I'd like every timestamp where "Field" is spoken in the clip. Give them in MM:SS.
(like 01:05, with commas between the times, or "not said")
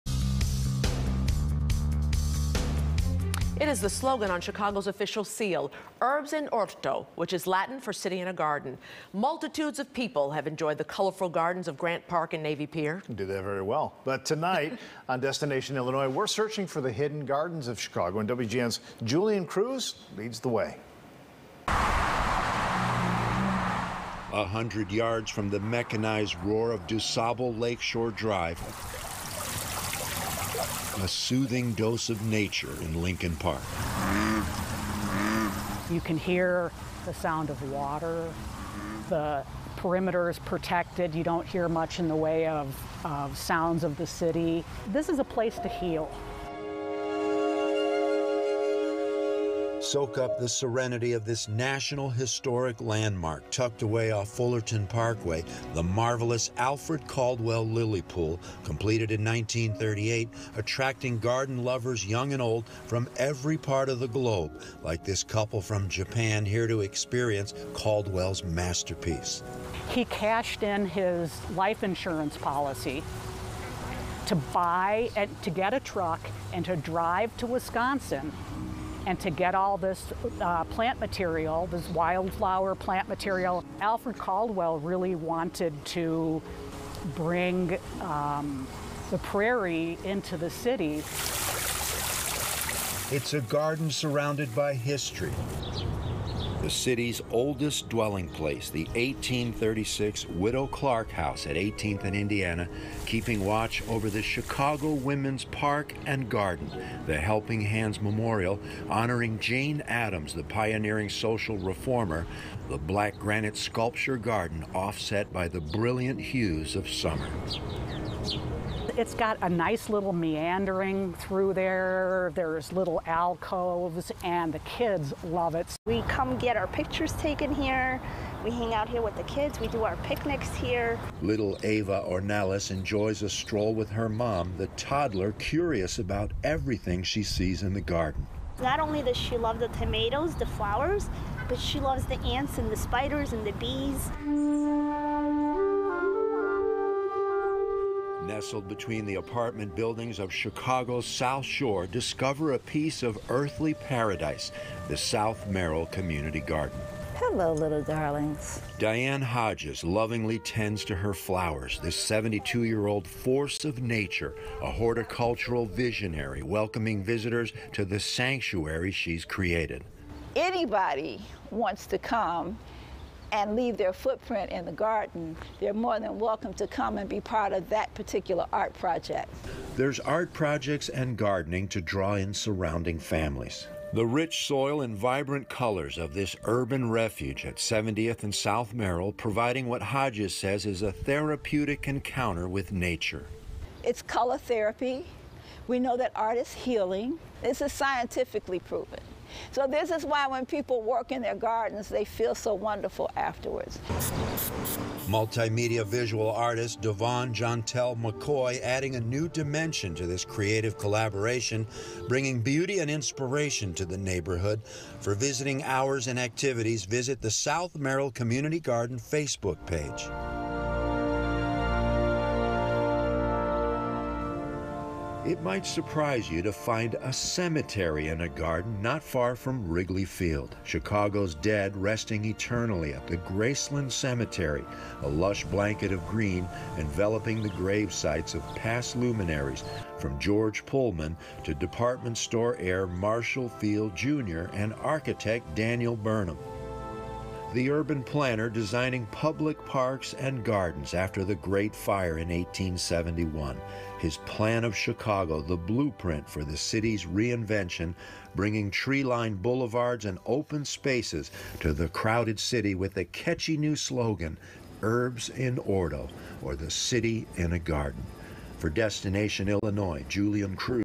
03:50, 04:03.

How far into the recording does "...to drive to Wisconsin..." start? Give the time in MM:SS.
01:16.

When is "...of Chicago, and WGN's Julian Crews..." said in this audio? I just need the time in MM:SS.
00:17.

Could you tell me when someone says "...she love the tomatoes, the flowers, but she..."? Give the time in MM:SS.
02:19.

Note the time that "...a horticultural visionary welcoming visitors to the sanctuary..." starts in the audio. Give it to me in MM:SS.
02:44.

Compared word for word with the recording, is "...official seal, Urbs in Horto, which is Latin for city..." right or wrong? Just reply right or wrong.
right.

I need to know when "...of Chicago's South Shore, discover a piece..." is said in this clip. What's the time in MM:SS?
02:30.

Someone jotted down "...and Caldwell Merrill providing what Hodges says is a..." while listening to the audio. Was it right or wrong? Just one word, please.
wrong.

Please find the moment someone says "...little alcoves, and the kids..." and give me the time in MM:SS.
02:02.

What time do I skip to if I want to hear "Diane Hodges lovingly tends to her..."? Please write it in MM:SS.
02:38.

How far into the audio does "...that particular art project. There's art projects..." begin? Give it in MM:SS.
02:57.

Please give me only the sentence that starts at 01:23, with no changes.
Alfred Caldwell really wanted to bring um, the prairie into the city.